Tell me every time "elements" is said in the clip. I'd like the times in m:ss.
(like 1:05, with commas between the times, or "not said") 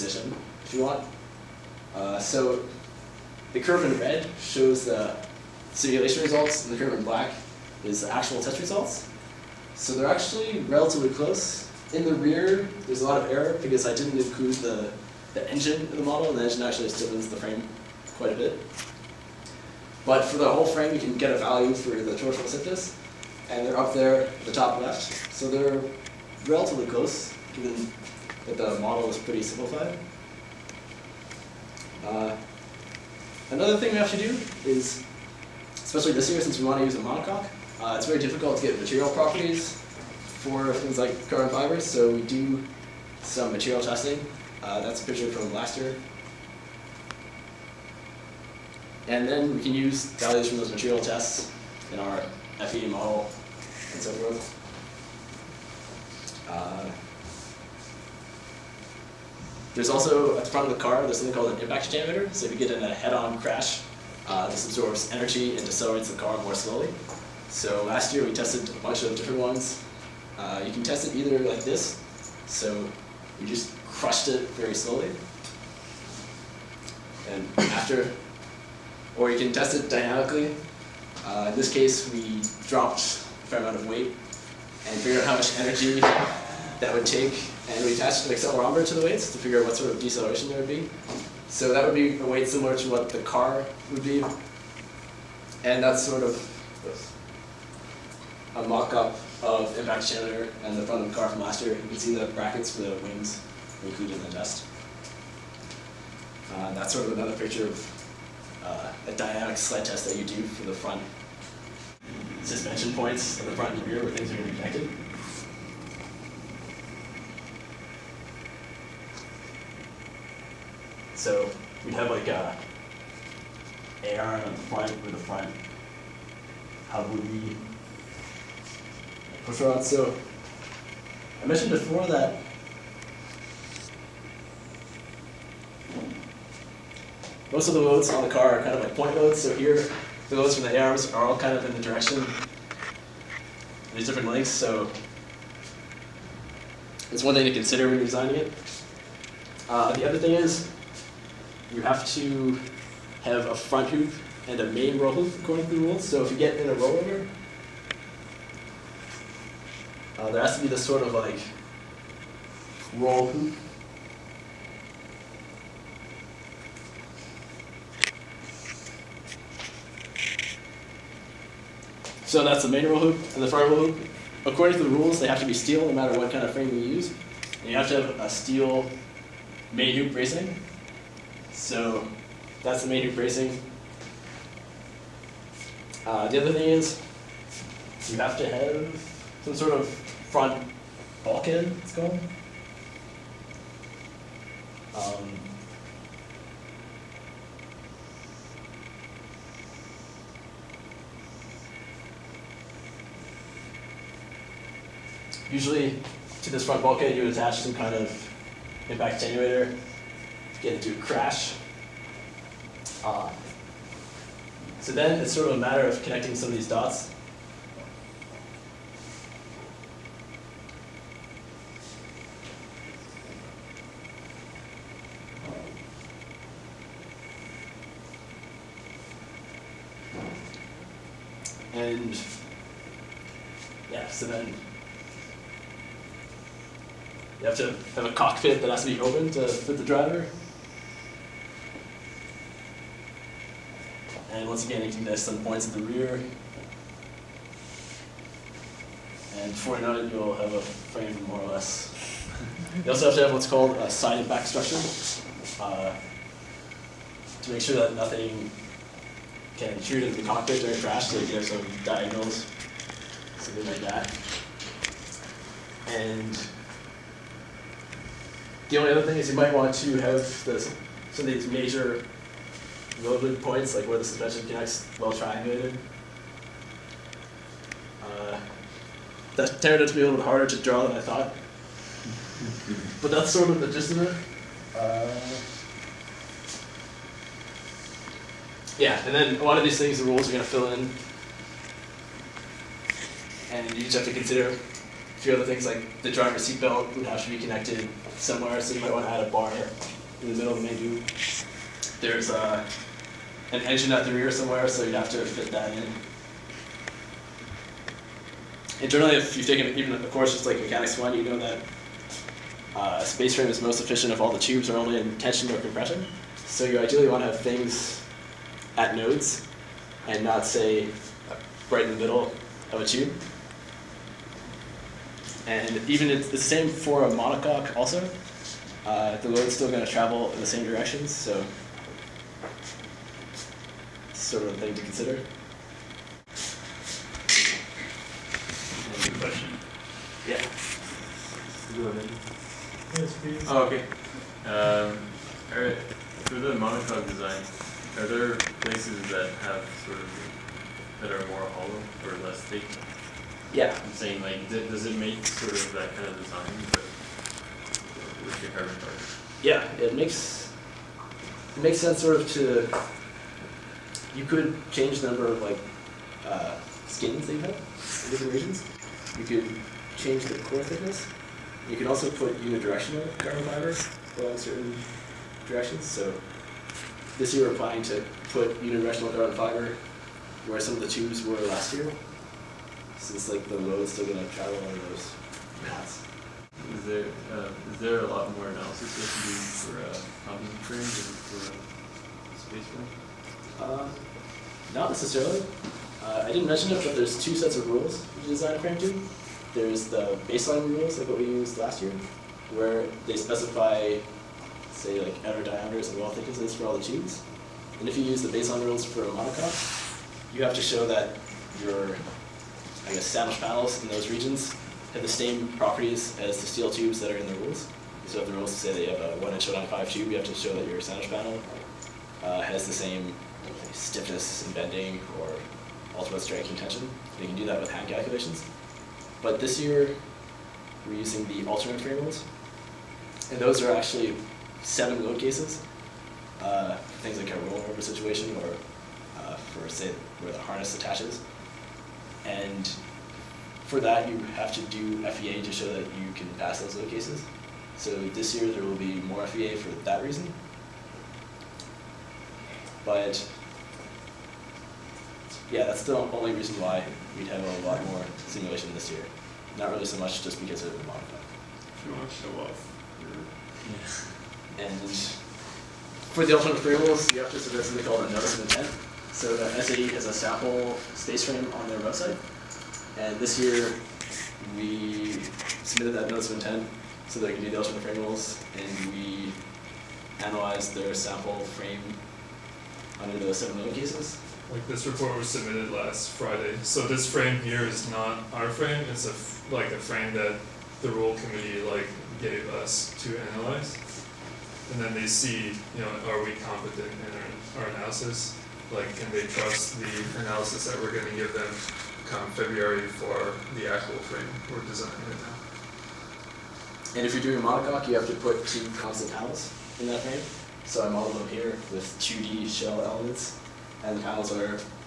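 8:32.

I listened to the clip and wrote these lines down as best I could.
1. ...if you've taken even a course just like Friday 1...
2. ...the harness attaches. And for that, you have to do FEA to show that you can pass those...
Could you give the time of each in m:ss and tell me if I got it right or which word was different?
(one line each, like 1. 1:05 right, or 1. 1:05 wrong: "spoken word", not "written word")
1. 5:09 wrong: "Mechanics", not "Friday"
2. 7:20 right.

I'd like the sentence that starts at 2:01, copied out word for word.
So we'd have like a arm on the front with the front Havuri push rod.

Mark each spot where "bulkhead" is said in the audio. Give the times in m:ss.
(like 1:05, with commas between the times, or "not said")
3:11, 3:26.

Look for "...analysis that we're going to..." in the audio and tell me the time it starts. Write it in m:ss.
8:20.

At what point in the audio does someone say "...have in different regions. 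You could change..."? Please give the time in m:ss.
6:07.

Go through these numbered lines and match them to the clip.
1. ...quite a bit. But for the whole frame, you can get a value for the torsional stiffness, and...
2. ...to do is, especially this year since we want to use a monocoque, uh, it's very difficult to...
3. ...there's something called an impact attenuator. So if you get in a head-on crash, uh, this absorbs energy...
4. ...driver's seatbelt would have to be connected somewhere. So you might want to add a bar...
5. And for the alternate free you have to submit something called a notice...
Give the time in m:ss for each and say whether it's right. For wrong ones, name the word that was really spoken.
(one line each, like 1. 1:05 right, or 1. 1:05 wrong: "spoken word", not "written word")
1. 0:18 right
2. 0:34 right
3. 1:01 right
4. 4:56 right
5. 7:44 right.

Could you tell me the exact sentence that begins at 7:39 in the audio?
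Not really so much just because of the modified.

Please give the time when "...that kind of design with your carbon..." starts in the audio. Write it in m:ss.
5:55.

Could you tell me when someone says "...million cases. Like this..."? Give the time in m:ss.
8:03.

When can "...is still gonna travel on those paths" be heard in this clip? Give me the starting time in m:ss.
6:23.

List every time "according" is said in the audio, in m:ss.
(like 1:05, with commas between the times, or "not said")
2:35, 2:54.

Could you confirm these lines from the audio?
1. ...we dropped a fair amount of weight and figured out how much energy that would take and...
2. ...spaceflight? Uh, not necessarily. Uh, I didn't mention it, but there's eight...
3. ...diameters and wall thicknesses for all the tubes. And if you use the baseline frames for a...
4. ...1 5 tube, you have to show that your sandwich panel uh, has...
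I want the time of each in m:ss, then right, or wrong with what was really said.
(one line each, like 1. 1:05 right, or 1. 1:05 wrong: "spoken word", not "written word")
1. 1:22 right
2. 6:32 wrong: "two", not "eight"
3. 6:45 wrong: "rules", not "frames"
4. 6:59 right.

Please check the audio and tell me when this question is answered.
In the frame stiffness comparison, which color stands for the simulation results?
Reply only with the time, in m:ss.
0:03.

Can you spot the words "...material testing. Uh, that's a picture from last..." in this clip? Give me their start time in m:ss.
0:43.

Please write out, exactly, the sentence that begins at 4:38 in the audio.
Uh, that turned out to be a little bit harder to draw than I thought.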